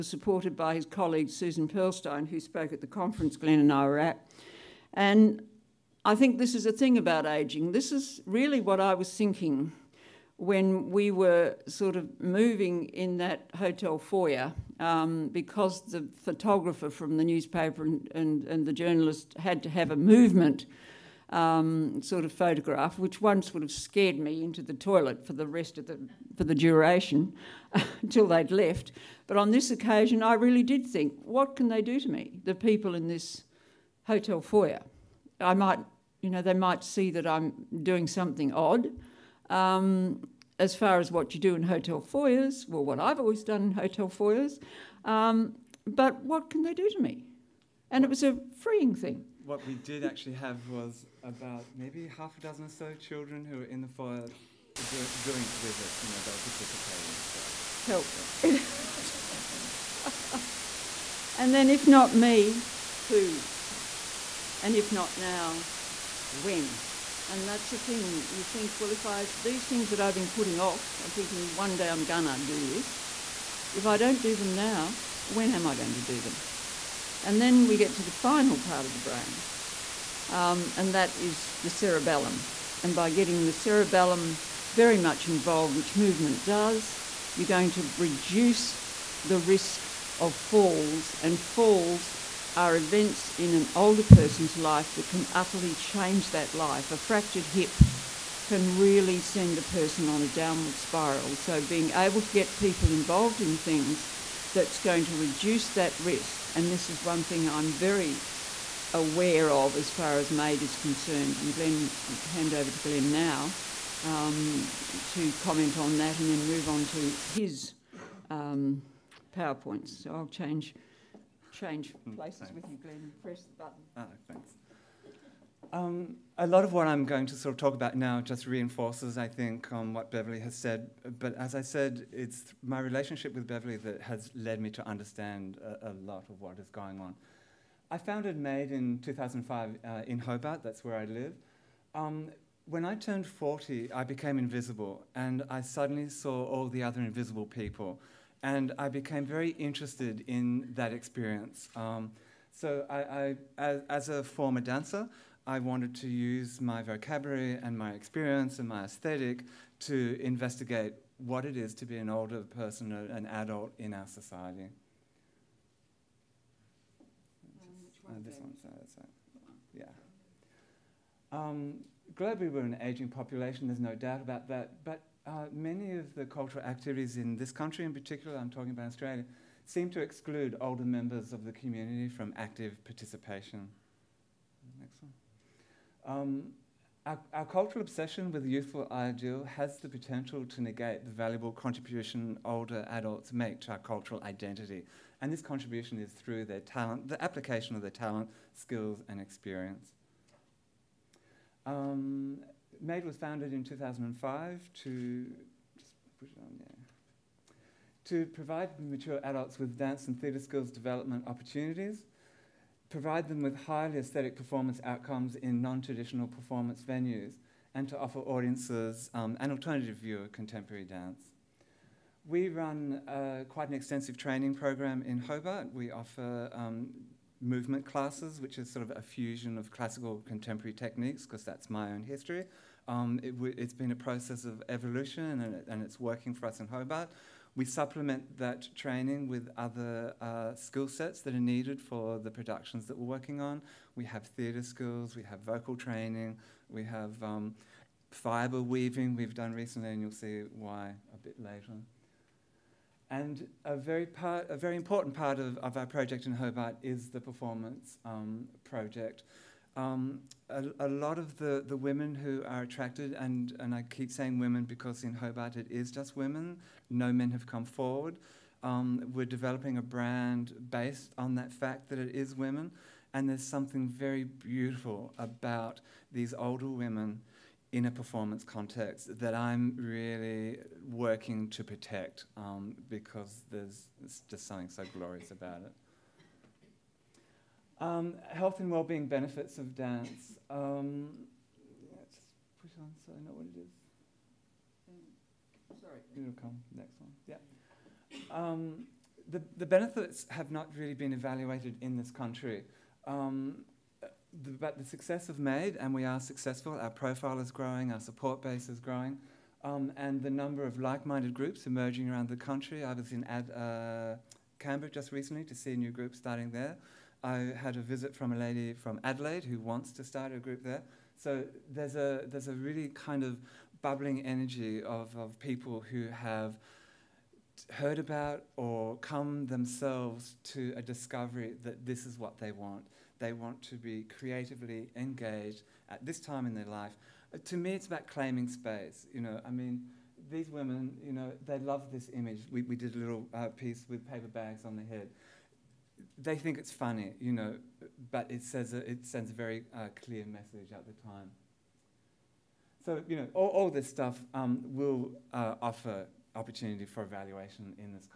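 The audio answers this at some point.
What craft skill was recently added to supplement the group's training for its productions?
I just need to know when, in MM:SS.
04:08.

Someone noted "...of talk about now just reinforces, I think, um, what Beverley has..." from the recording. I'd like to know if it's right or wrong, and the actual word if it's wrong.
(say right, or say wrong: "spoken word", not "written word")
right.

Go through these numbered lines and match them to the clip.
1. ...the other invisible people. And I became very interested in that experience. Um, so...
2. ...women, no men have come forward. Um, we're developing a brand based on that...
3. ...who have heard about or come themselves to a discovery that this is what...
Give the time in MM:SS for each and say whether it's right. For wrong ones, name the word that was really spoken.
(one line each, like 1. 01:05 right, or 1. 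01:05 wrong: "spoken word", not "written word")
1. 02:26 right
2. 04:26 right
3. 05:25 right.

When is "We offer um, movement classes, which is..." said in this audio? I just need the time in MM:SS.
03:45.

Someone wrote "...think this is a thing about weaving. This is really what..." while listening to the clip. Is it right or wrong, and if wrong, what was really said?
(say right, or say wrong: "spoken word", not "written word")
wrong: "aging", not "weaving".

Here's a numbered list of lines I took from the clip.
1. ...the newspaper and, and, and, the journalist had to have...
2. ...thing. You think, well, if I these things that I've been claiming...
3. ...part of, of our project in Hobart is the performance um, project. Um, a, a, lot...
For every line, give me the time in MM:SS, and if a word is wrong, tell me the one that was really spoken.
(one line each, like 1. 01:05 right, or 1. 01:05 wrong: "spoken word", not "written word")
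1. 00:17 right
2. 01:07 wrong: "putting", not "claiming"
3. 04:15 right.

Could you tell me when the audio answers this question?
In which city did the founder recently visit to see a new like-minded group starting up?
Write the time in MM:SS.
05:14.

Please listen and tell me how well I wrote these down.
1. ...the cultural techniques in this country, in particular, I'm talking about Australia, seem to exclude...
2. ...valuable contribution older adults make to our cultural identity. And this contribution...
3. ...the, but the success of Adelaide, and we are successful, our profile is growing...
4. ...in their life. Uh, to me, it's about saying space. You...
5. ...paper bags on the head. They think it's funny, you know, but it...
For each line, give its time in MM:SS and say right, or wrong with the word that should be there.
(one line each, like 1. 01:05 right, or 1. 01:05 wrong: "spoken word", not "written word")
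1. 02:56 wrong: "activities", not "techniques"
2. 03:11 right
3. 05:04 wrong: "MADE", not "Adelaide"
4. 05:36 wrong: "claiming", not "saying"
5. 05:44 right.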